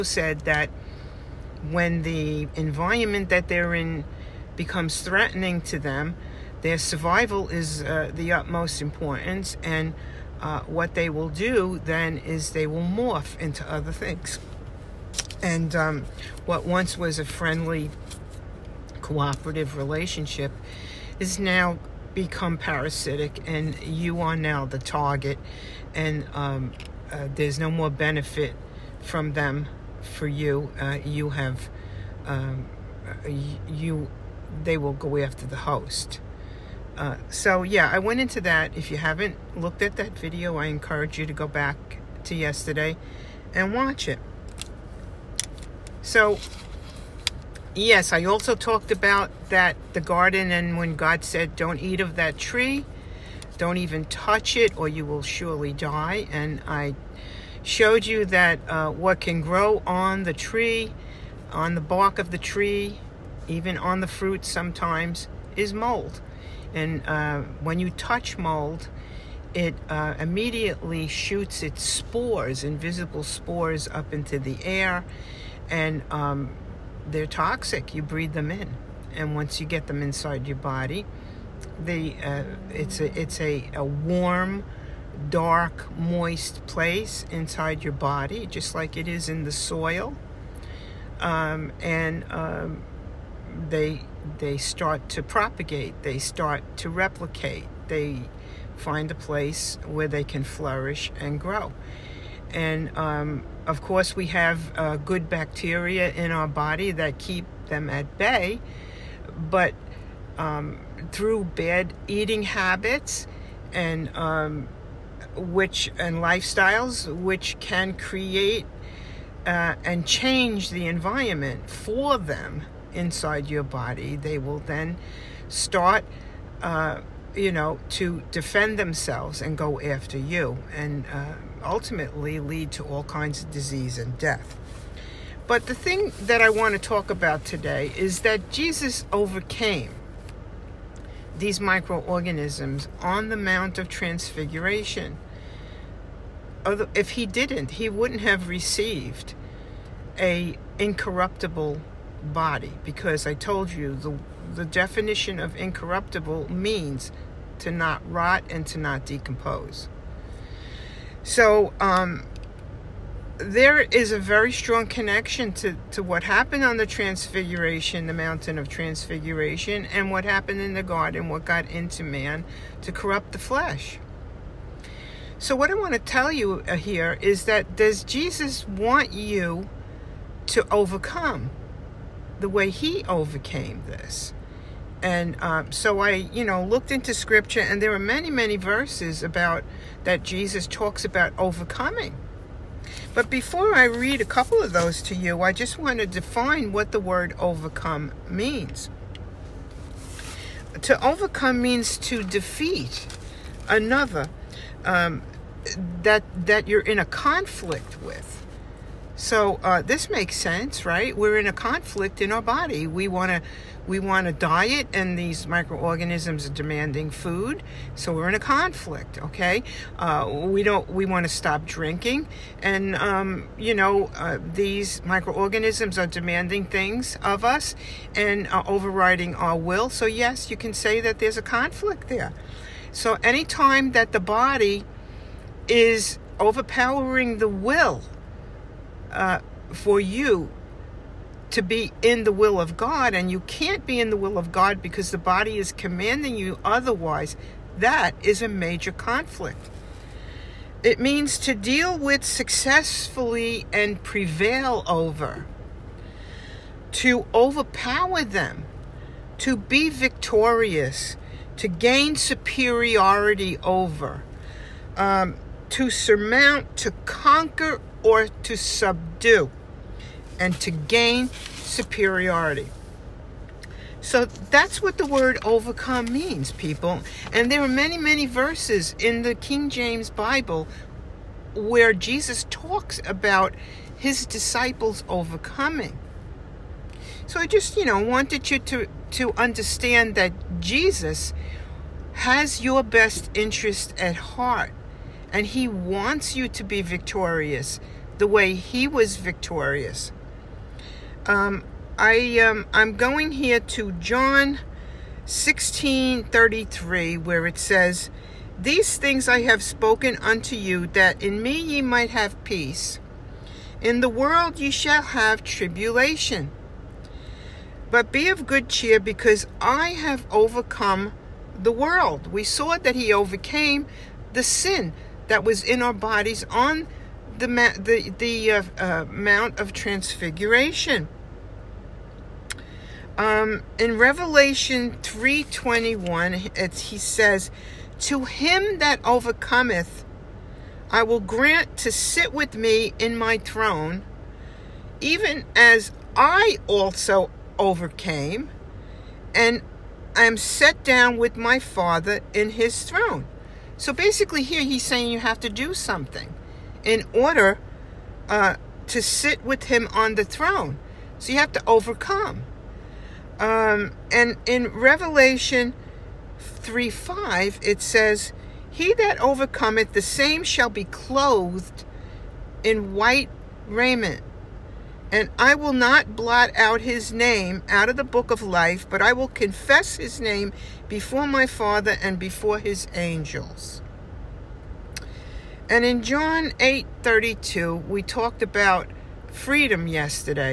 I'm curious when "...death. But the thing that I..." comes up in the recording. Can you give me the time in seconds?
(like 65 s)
134 s.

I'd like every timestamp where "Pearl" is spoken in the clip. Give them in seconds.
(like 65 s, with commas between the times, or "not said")
not said.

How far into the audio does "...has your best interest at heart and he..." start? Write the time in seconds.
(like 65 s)
292 s.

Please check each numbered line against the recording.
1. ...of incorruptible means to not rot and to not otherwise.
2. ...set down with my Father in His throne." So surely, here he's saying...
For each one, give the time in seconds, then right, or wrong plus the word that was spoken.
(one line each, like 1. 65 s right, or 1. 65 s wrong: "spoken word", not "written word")
1. 155 s wrong: "decompose", not "otherwise"
2. 350 s wrong: "basically", not "surely".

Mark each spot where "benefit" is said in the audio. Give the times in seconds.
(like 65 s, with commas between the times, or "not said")
27 s.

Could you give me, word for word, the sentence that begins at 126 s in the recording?
Uh, you know, to defend themselves and go after you.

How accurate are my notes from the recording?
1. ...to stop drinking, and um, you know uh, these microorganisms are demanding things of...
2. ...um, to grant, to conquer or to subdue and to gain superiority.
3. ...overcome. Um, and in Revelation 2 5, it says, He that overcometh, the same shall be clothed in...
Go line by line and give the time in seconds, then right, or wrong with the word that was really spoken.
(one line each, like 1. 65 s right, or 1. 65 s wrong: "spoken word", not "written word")
1. 221 s right
2. 264 s wrong: "surmount", not "grant"
3. 361 s wrong: "3", not "2".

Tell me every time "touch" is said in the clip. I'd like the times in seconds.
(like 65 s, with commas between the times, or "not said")
54 s, 67 s.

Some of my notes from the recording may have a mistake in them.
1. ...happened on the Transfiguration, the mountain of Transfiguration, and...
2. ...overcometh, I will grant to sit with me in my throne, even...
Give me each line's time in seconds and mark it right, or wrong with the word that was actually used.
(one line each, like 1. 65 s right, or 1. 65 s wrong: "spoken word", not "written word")
1. 166 s right
2. 339 s right.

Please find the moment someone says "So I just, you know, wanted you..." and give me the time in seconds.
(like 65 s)
287 s.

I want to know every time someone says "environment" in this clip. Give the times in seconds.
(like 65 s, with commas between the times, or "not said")
2 s, 120 s.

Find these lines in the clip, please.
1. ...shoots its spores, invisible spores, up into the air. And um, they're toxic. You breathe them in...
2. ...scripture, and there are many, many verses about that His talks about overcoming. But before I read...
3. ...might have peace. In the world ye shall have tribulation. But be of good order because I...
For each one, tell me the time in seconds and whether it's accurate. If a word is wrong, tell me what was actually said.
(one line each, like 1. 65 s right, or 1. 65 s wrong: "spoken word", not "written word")
1. 71 s right
2. 187 s wrong: "Jesus", not "His"
3. 311 s wrong: "cheer", not "order".